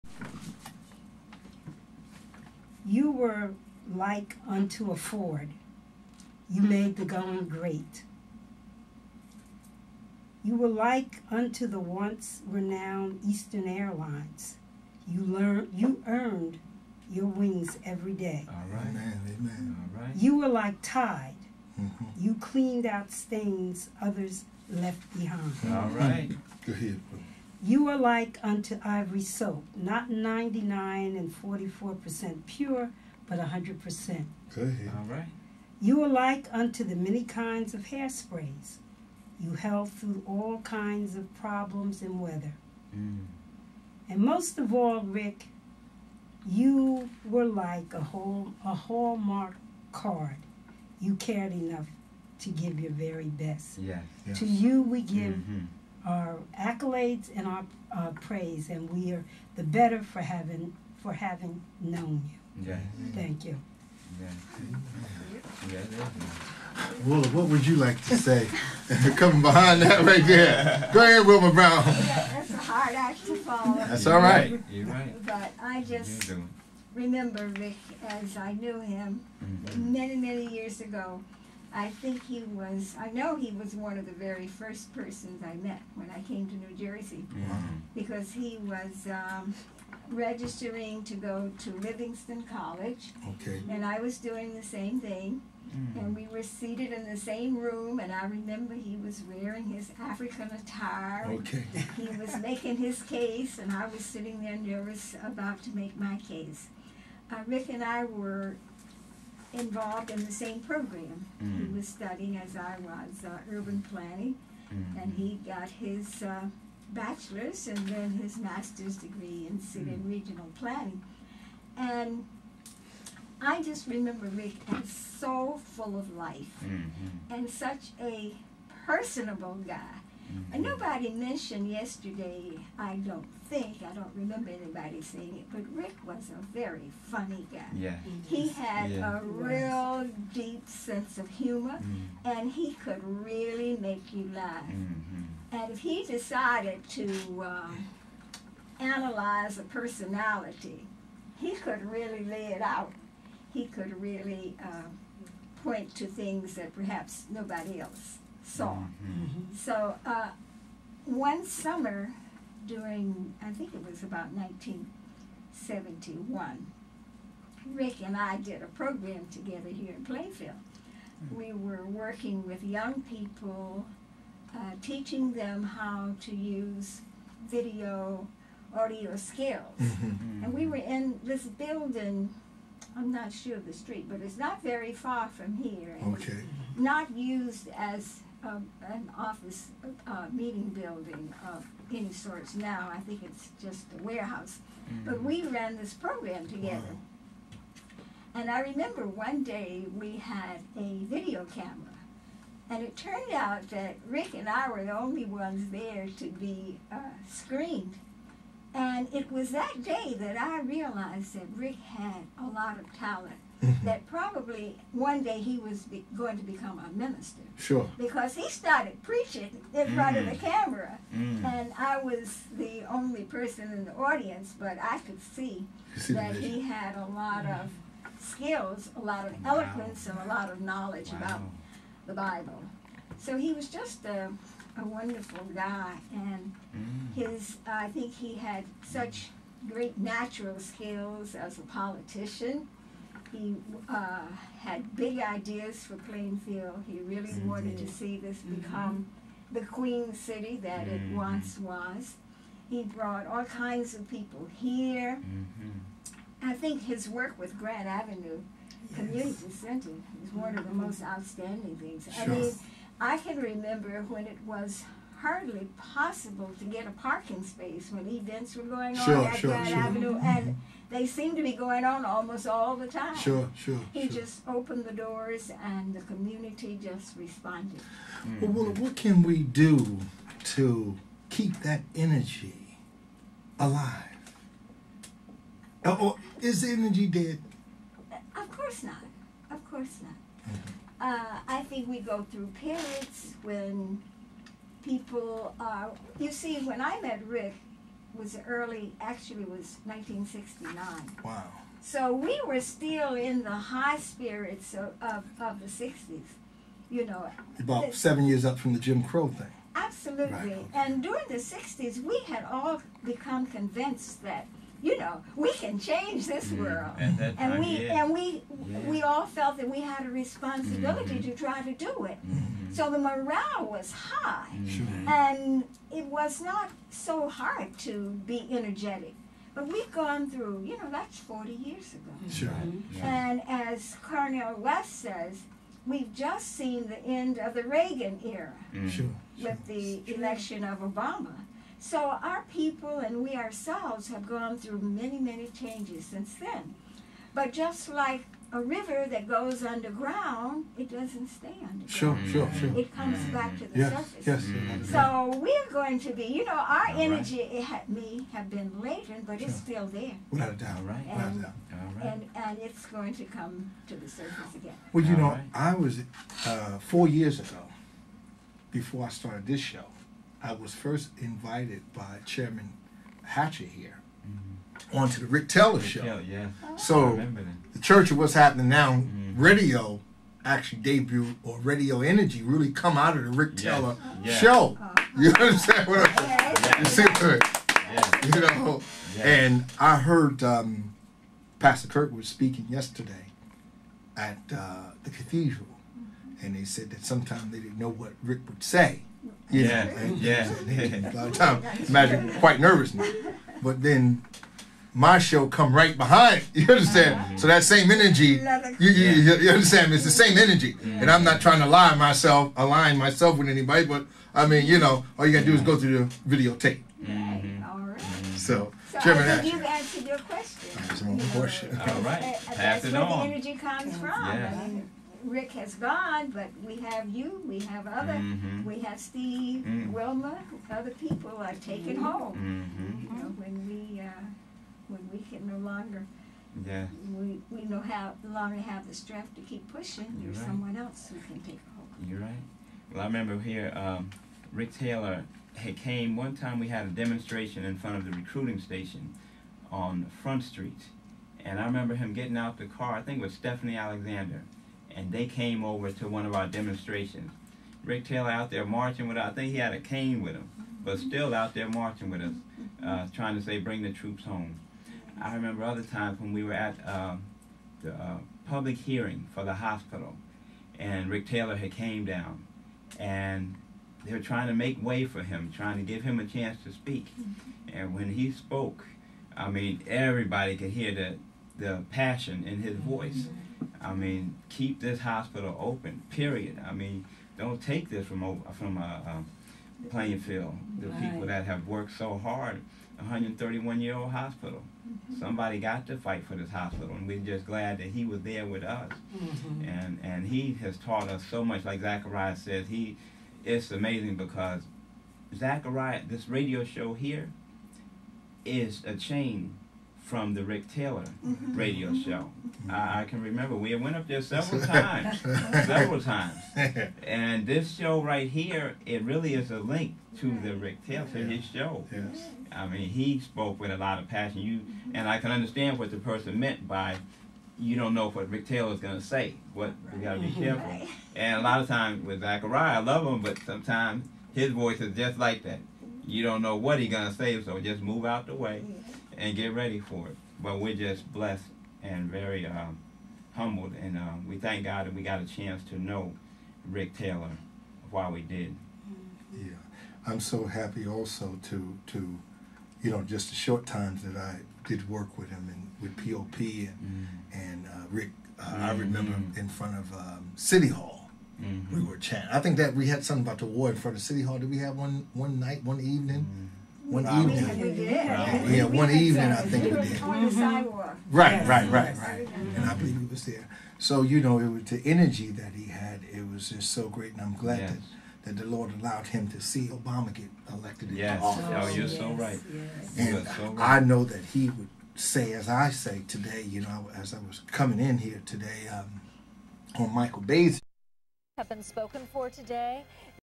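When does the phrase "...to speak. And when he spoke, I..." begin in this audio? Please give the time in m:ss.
7:56.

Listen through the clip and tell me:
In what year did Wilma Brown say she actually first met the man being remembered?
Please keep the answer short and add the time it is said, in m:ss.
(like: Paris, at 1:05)
1969, at 4:59.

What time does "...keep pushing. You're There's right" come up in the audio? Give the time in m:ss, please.
7:19.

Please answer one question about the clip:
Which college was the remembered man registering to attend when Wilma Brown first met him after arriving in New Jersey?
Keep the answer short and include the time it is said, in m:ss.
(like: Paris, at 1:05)
Livingston College, at 1:31.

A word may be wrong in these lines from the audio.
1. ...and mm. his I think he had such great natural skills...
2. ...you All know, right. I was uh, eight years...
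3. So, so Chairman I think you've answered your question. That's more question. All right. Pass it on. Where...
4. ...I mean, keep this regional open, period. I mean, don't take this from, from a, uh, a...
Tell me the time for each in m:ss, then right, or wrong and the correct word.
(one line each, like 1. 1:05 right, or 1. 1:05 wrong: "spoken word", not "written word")
1. 3:56 right
2. 6:05 wrong: "four", not "eight"
3. 6:58 right
4. 8:03 wrong: "hospital", not "regional".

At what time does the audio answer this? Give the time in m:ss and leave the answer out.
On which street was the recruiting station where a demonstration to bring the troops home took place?
7:30.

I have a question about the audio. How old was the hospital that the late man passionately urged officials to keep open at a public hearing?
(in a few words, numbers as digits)
131 years.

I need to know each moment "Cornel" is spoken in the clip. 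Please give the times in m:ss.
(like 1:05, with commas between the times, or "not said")
5:34.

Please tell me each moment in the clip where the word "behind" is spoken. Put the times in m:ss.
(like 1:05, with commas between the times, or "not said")
0:25, 1:09, 6:45.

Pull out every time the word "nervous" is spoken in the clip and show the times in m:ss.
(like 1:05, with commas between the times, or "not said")
1:44, 6:42.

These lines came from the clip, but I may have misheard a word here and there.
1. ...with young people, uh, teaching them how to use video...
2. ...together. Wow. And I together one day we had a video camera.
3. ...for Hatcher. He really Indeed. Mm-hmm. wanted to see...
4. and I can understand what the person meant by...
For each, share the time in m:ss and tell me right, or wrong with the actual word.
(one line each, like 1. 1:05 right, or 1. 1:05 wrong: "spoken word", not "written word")
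1. 2:52 right
2. 3:16 wrong: "remember", not "together"
3. 4:05 wrong: "Plainfield", not "Hatcher"
4. 8:44 right.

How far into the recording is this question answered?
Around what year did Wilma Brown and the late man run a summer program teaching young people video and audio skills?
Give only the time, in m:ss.
2:44.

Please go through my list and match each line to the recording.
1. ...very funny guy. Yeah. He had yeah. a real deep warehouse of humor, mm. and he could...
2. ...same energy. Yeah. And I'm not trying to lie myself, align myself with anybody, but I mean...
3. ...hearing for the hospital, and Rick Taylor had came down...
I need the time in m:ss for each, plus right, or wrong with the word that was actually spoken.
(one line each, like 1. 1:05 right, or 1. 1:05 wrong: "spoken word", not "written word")
1. 2:16 wrong: "sense", not "warehouse"
2. 6:50 right
3. 7:48 right.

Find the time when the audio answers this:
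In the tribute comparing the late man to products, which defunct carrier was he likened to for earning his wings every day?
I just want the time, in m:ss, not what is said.
0:13.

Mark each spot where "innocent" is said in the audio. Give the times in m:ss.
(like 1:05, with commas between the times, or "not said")
not said.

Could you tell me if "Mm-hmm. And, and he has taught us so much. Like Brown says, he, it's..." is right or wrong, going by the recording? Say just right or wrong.
wrong.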